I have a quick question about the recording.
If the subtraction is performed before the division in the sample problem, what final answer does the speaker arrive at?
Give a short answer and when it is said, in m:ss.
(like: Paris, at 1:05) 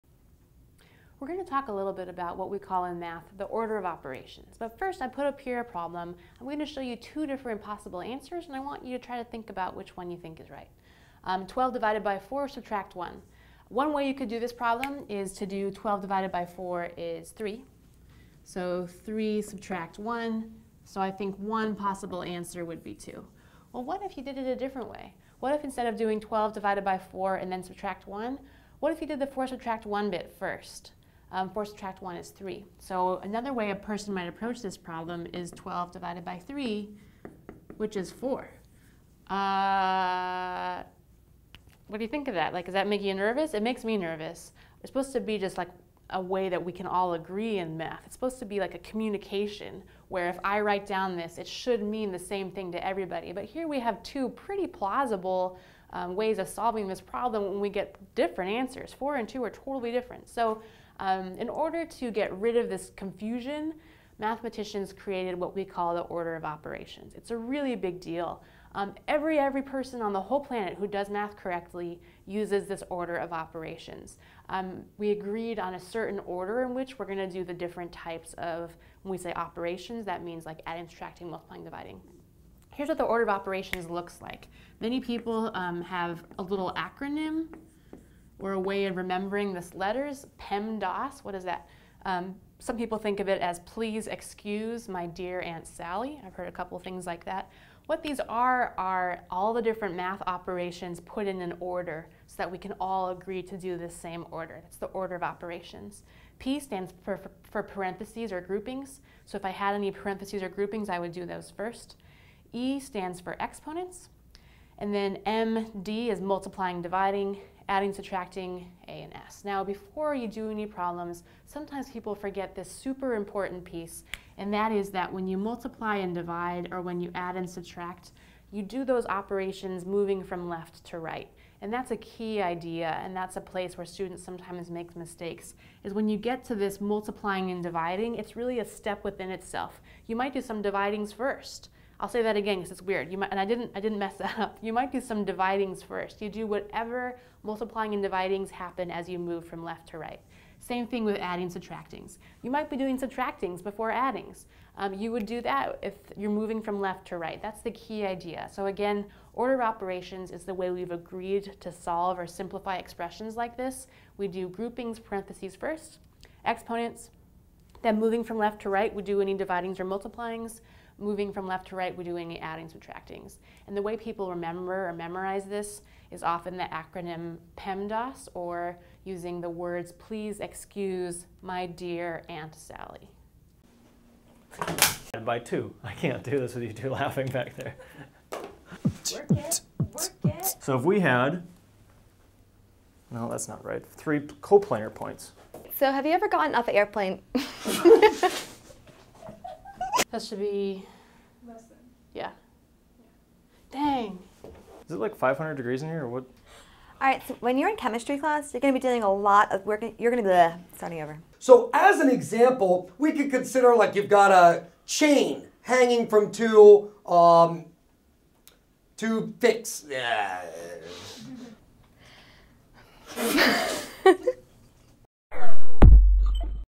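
4, at 0:35.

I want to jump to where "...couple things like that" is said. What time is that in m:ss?
1:36.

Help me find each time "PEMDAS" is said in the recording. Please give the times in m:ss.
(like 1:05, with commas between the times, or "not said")
1:30, 2:57.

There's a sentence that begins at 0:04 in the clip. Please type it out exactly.
But first, I put up here a problem.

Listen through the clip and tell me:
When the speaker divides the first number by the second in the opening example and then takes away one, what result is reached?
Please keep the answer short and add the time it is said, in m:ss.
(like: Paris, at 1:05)
2, at 0:20.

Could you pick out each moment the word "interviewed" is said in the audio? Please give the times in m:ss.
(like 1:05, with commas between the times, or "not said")
not said.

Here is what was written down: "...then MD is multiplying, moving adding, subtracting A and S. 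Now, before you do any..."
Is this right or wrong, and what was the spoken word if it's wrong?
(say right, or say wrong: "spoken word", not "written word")
wrong: "dividing", not "moving".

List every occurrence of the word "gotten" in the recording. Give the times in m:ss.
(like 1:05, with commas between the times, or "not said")
3:16.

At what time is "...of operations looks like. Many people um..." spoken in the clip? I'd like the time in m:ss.
1:23.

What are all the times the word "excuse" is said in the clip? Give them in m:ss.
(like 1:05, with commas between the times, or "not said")
1:34, 3:00.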